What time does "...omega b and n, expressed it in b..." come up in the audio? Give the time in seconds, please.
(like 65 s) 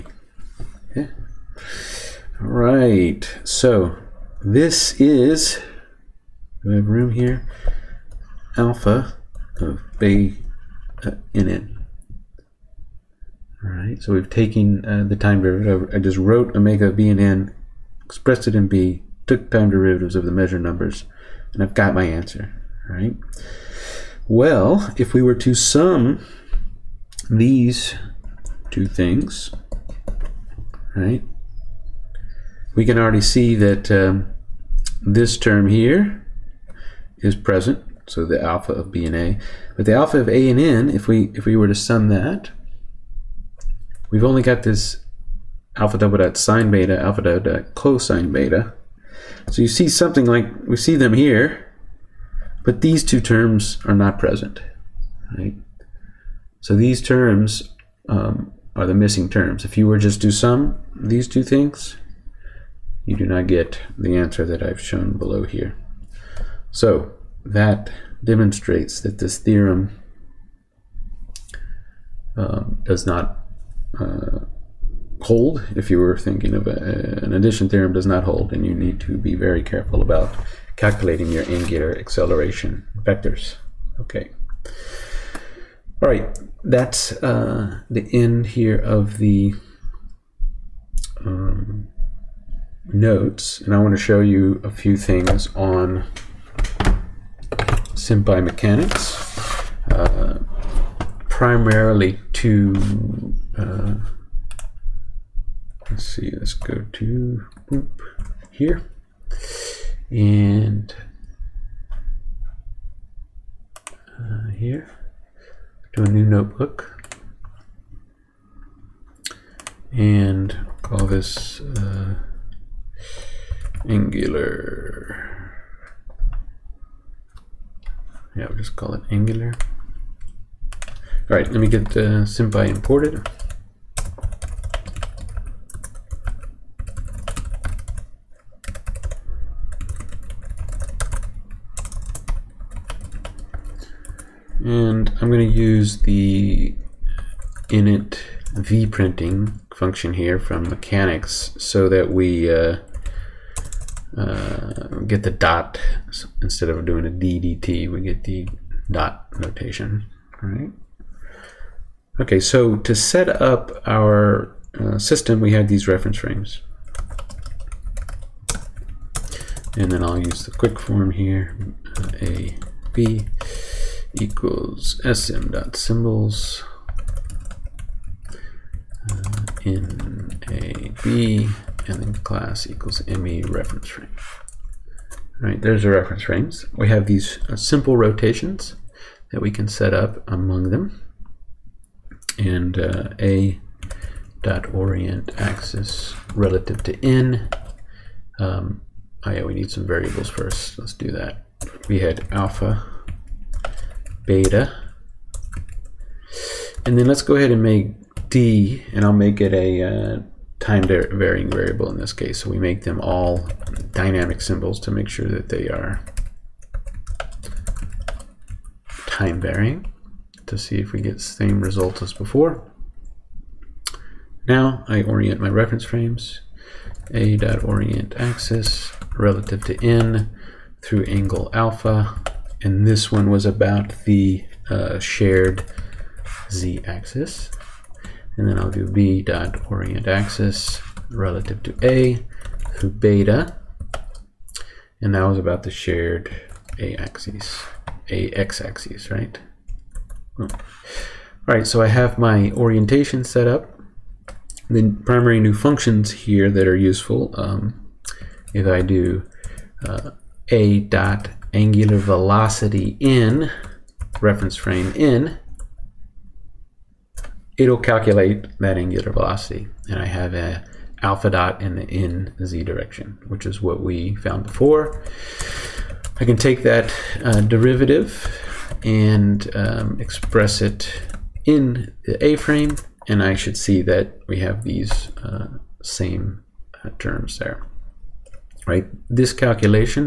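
16 s.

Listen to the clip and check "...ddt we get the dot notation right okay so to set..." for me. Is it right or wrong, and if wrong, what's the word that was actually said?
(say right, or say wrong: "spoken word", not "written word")
right.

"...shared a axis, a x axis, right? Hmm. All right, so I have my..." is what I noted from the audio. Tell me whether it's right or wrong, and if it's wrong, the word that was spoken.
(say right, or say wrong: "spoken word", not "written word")
right.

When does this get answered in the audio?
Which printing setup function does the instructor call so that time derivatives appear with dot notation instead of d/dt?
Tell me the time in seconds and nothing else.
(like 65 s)
147 s.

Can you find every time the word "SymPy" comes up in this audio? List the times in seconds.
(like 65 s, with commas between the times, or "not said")
98 s, 132 s.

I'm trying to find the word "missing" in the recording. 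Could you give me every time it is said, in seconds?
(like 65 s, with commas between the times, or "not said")
58 s.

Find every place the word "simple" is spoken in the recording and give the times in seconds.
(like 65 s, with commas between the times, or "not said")
187 s.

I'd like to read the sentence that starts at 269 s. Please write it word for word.
And I have a alpha dot in the in z direction, which is what we found before.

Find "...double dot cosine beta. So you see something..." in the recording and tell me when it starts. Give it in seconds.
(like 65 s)
47 s.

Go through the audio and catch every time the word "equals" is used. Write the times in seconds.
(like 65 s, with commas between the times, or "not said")
174 s, 182 s.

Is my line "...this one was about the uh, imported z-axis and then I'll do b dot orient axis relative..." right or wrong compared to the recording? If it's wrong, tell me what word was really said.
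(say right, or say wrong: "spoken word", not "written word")
wrong: "shared", not "imported".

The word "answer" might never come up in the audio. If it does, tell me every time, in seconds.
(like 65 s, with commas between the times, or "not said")
22 s, 64 s.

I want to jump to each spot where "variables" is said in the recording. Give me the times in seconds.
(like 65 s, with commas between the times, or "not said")
199 s, 211 s.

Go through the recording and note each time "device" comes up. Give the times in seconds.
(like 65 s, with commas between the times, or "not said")
not said.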